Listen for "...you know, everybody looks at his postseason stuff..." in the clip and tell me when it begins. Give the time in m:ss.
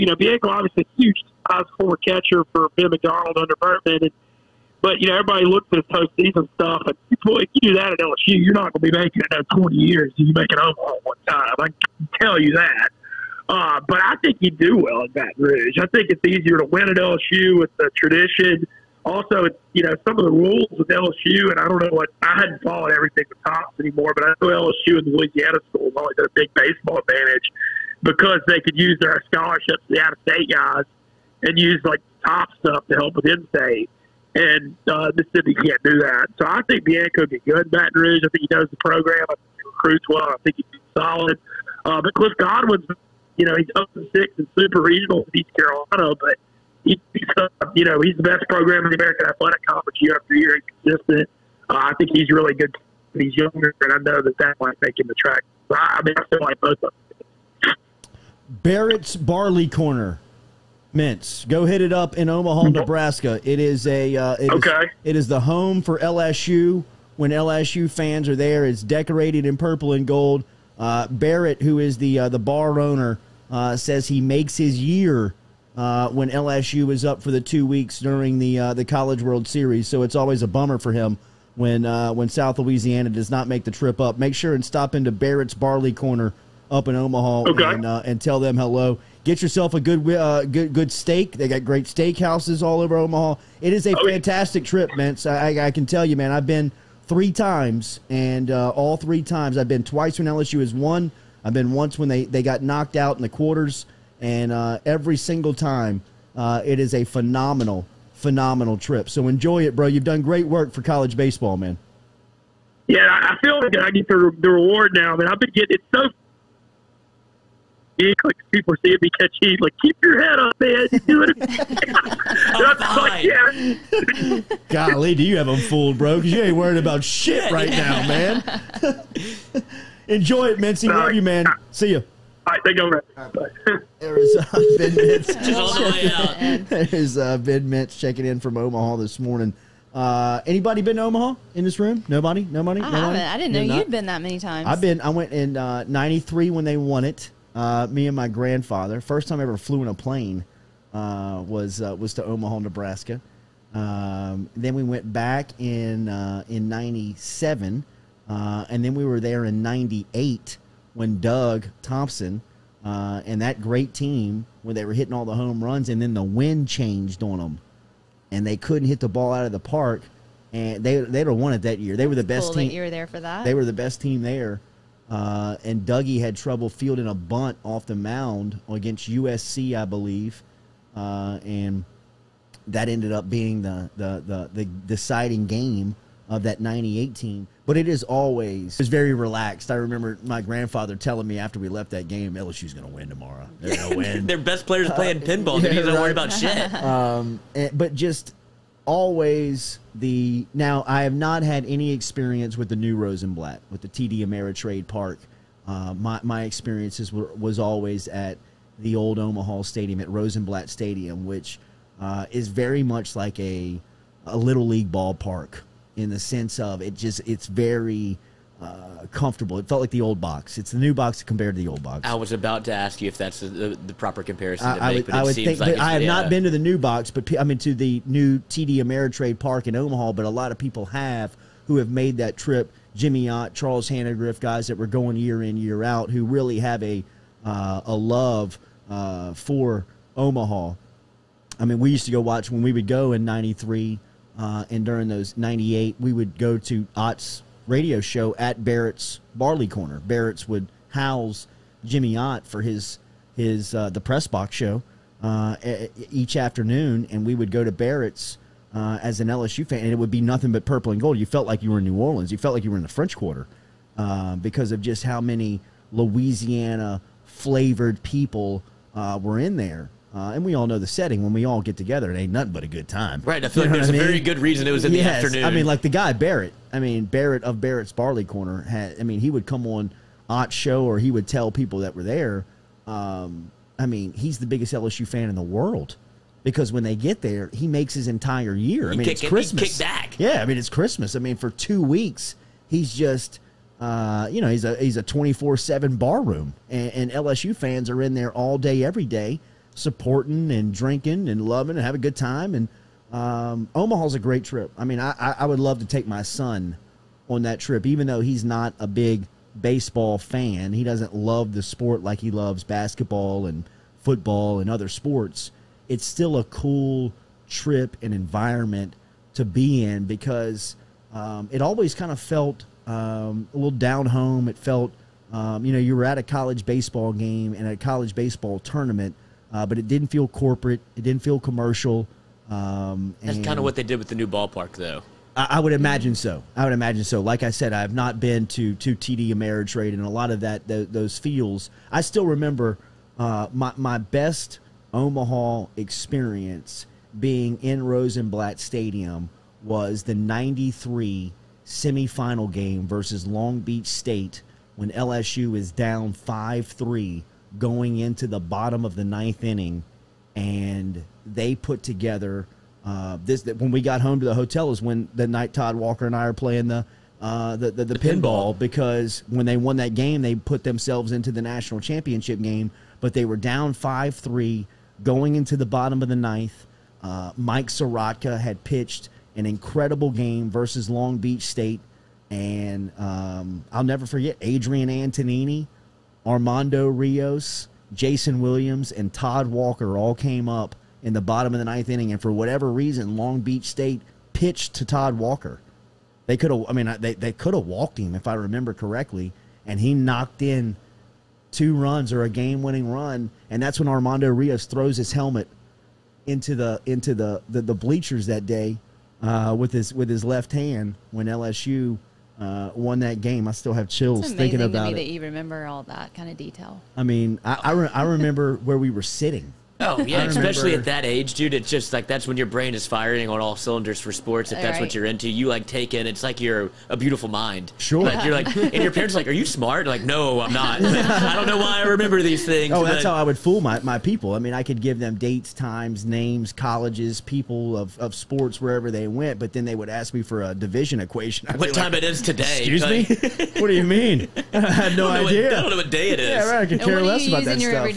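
0:05.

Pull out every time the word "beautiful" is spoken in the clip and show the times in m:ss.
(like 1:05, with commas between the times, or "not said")
7:06.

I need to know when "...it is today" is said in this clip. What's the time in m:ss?
7:22.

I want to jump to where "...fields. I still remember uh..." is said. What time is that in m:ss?
5:41.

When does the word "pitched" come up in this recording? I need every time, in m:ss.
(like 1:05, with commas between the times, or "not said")
6:18, 6:34.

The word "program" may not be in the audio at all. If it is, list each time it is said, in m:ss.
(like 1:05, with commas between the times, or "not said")
0:38, 0:48.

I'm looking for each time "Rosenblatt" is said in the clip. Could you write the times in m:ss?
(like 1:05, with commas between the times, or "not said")
3:22, 3:30, 5:47.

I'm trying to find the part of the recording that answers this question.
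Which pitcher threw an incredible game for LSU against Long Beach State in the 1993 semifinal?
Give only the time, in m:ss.
6:17.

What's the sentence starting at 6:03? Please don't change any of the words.
That when we got home to the hotel is when the night Todd Walker and I are playing the.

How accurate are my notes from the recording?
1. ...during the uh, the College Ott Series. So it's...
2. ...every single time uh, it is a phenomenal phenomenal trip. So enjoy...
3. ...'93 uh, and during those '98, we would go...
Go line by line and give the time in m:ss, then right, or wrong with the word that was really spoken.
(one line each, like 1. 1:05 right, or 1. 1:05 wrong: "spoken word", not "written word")
1. 1:17 wrong: "World", not "Ott"
2. 1:44 right
3. 4:03 right.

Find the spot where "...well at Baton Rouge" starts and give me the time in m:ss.
0:14.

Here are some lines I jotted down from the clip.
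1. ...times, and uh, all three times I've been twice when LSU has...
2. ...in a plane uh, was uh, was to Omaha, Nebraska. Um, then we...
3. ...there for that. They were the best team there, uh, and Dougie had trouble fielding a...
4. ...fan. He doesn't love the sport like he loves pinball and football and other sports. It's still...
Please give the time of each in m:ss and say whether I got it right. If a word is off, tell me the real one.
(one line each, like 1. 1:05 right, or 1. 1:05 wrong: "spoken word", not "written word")
1. 1:37 right
2. 2:29 right
3. 2:52 right
4. 5:10 wrong: "basketball", not "pinball".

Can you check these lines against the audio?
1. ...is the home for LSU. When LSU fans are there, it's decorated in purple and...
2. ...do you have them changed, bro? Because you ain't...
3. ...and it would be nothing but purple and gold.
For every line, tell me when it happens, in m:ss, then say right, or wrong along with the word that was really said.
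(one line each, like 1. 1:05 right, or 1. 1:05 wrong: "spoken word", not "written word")
1. 1:05 right
2. 2:05 wrong: "fooled", not "changed"
3. 4:19 right.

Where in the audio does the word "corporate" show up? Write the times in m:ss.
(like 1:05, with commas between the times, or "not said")
5:30.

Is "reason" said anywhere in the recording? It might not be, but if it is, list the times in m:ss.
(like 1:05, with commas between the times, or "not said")
4:34, 6:32.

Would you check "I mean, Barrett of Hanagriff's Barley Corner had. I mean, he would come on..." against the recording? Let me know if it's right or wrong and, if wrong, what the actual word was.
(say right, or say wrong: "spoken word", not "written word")
wrong: "Barrett", not "Hanagriff".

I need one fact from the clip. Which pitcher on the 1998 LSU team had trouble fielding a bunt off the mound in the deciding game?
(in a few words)
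Doug Thompson.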